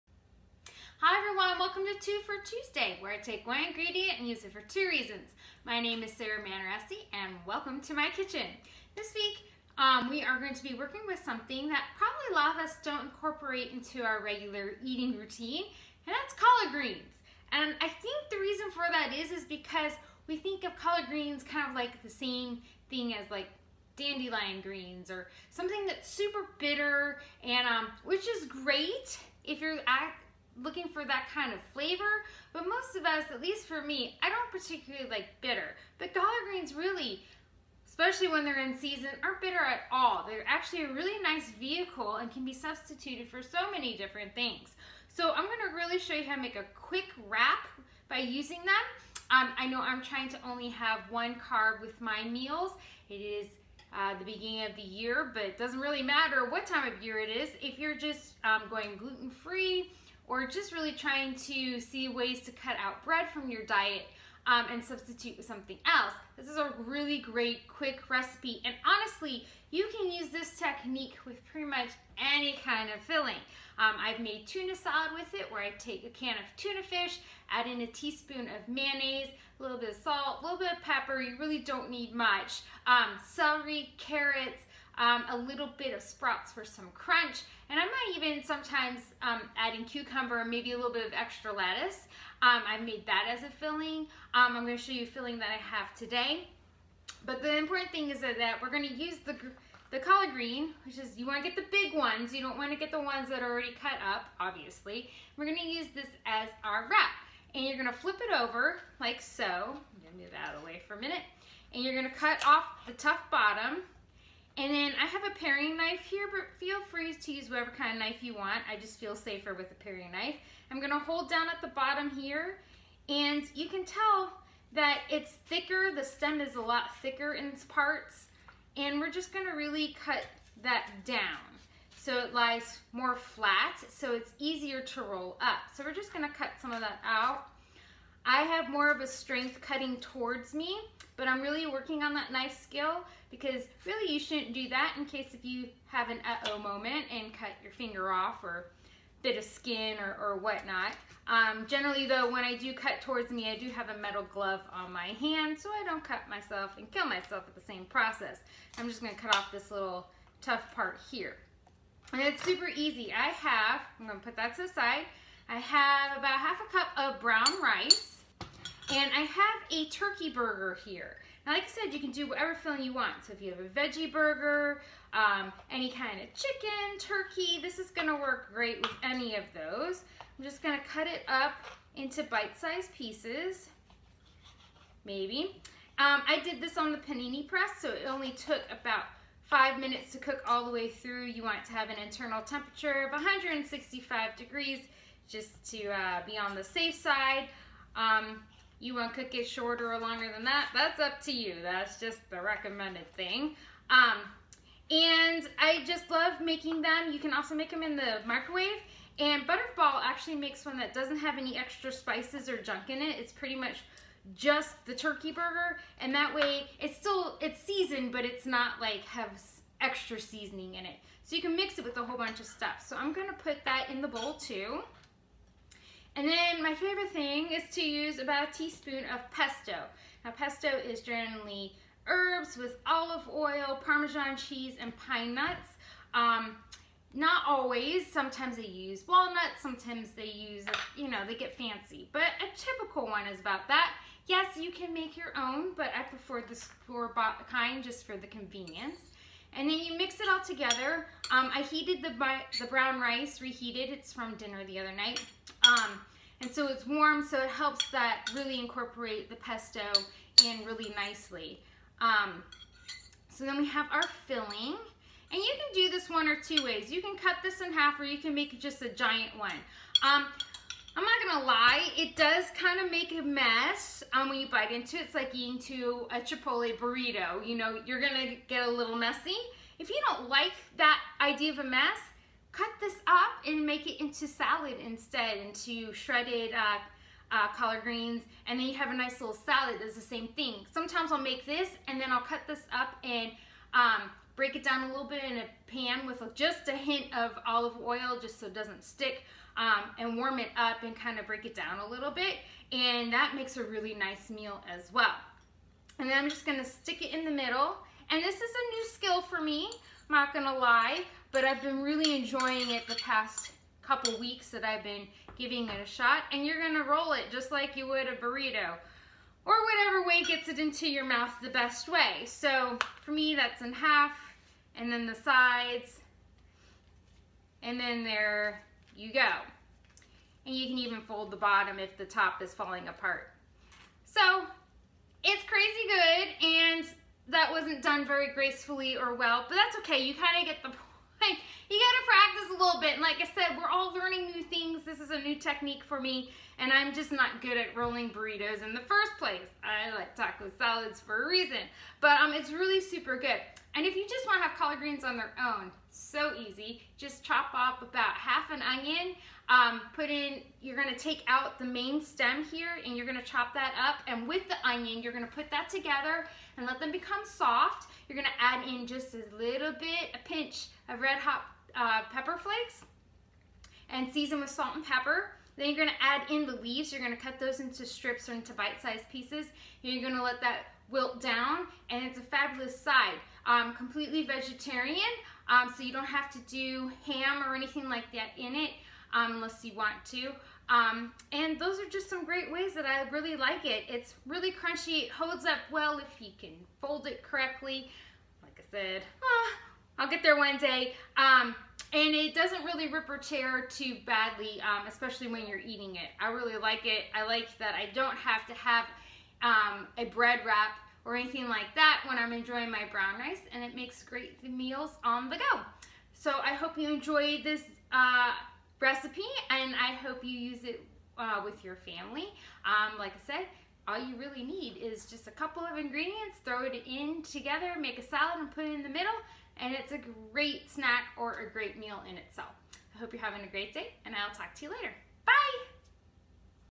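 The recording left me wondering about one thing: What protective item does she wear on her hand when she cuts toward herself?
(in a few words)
metal glove.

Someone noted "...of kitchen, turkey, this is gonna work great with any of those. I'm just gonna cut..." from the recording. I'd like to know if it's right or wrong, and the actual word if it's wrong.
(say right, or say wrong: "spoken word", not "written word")
wrong: "chicken", not "kitchen".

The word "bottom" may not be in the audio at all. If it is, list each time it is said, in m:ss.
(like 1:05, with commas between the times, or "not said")
1:53, 2:01, 5:31.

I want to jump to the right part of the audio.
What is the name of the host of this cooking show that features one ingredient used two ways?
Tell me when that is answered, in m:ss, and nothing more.
0:06.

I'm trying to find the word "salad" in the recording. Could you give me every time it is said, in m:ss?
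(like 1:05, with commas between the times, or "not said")
1:14, 4:44, 4:49, 5:50, 7:08.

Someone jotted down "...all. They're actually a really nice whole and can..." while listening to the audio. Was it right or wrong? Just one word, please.
wrong.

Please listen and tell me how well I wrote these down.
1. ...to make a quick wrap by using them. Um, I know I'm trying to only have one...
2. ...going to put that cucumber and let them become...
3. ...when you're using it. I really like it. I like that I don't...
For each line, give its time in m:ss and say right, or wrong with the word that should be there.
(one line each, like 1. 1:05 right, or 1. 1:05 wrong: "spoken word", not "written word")
1. 0:46 right
2. 6:05 wrong: "together", not "cucumber"
3. 6:45 wrong: "eating", not "using".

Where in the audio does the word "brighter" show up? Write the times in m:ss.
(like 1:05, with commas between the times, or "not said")
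not said.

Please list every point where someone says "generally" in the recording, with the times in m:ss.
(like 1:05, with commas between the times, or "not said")
2:31, 3:51.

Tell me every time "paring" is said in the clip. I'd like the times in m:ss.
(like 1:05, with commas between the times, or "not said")
1:55, 1:59.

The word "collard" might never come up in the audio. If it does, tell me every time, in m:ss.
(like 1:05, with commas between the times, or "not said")
0:16, 0:20, 0:36, 1:39, 4:47, 5:54.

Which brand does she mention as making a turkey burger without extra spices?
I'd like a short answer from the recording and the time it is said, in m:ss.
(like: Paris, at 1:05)
Butterball, at 3:29.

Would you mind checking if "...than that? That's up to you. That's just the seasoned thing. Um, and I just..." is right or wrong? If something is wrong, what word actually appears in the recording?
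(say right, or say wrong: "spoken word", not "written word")
wrong: "recommended", not "seasoned".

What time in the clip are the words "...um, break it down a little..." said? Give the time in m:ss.
4:53.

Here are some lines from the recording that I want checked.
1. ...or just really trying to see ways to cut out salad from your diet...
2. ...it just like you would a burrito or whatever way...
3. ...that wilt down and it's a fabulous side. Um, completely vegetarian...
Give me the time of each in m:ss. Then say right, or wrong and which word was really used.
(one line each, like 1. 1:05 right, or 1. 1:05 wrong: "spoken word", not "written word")
1. 1:00 wrong: "bread", not "salad"
2. 5:17 right
3. 6:20 right.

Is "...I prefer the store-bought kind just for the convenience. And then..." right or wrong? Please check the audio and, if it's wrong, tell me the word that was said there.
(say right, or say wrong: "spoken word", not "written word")
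right.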